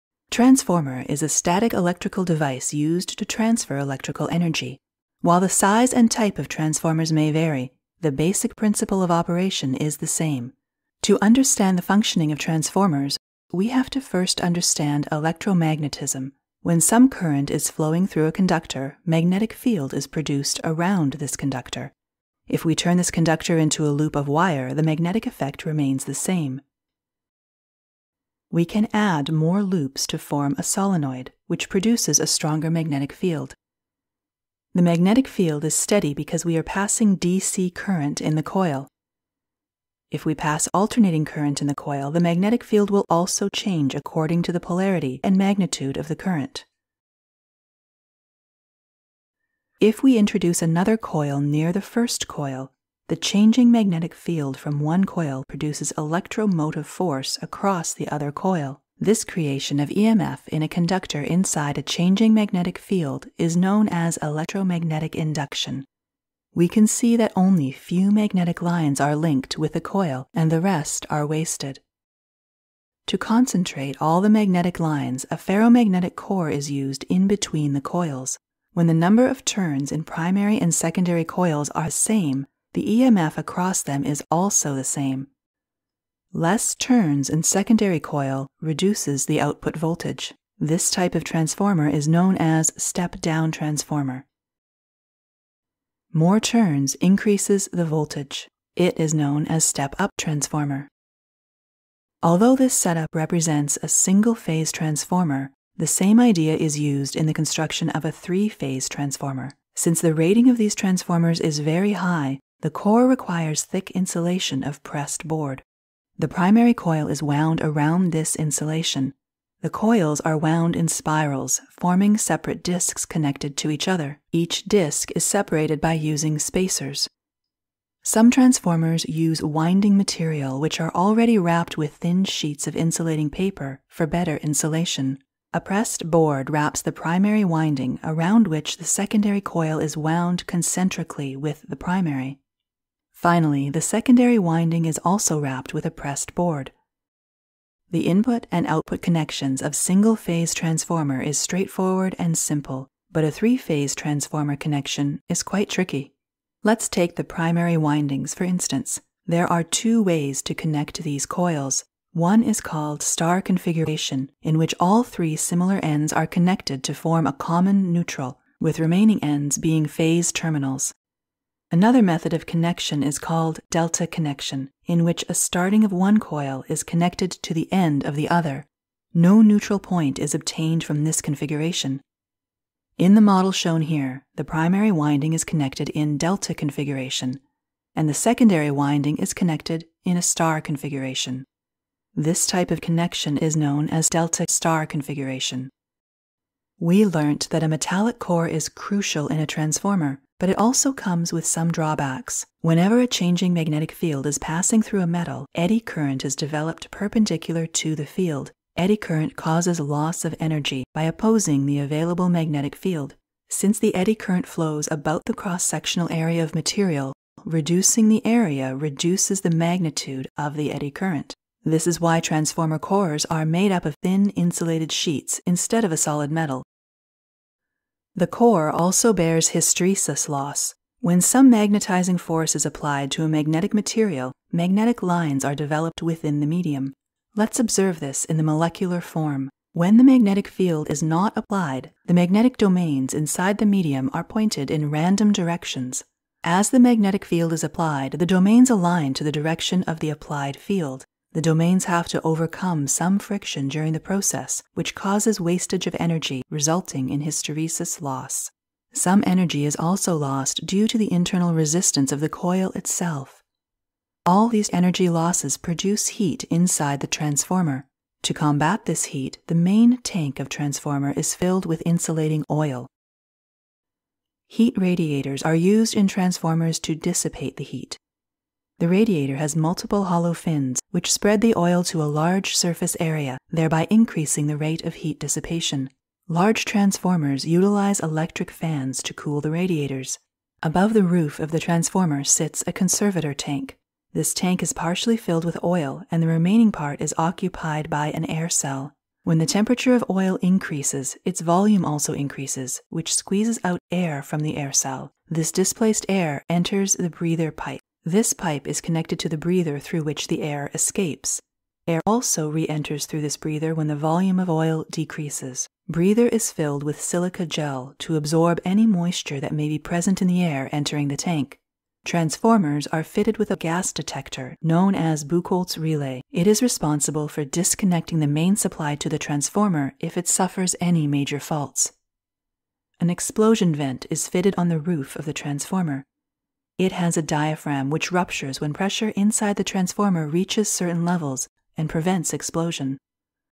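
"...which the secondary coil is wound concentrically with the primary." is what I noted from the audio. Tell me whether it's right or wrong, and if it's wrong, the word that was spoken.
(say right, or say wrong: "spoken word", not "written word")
right.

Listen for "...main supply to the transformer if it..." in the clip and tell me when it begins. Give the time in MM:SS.
05:28.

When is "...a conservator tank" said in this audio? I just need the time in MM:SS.
04:52.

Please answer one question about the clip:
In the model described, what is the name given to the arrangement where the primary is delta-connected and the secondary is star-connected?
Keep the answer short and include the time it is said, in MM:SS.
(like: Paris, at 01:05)
delta star configuration, at 03:14.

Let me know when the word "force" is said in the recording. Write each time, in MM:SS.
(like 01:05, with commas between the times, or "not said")
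00:56, 03:52.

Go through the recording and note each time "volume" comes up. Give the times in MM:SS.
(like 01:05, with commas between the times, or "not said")
05:01, 05:13.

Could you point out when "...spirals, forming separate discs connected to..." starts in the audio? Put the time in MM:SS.
02:00.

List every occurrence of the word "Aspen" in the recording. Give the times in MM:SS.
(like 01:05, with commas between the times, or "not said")
not said.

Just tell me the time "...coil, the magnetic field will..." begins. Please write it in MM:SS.
00:41.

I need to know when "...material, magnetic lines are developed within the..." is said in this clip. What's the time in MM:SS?
03:53.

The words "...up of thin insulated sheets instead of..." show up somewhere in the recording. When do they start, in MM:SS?
03:43.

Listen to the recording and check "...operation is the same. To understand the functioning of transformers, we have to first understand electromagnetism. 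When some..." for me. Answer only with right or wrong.
right.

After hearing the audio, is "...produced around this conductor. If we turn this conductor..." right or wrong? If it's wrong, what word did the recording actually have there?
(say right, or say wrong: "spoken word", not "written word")
right.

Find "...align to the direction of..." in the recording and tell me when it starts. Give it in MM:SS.
04:08.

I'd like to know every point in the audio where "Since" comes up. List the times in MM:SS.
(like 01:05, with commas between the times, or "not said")
01:49, 03:33.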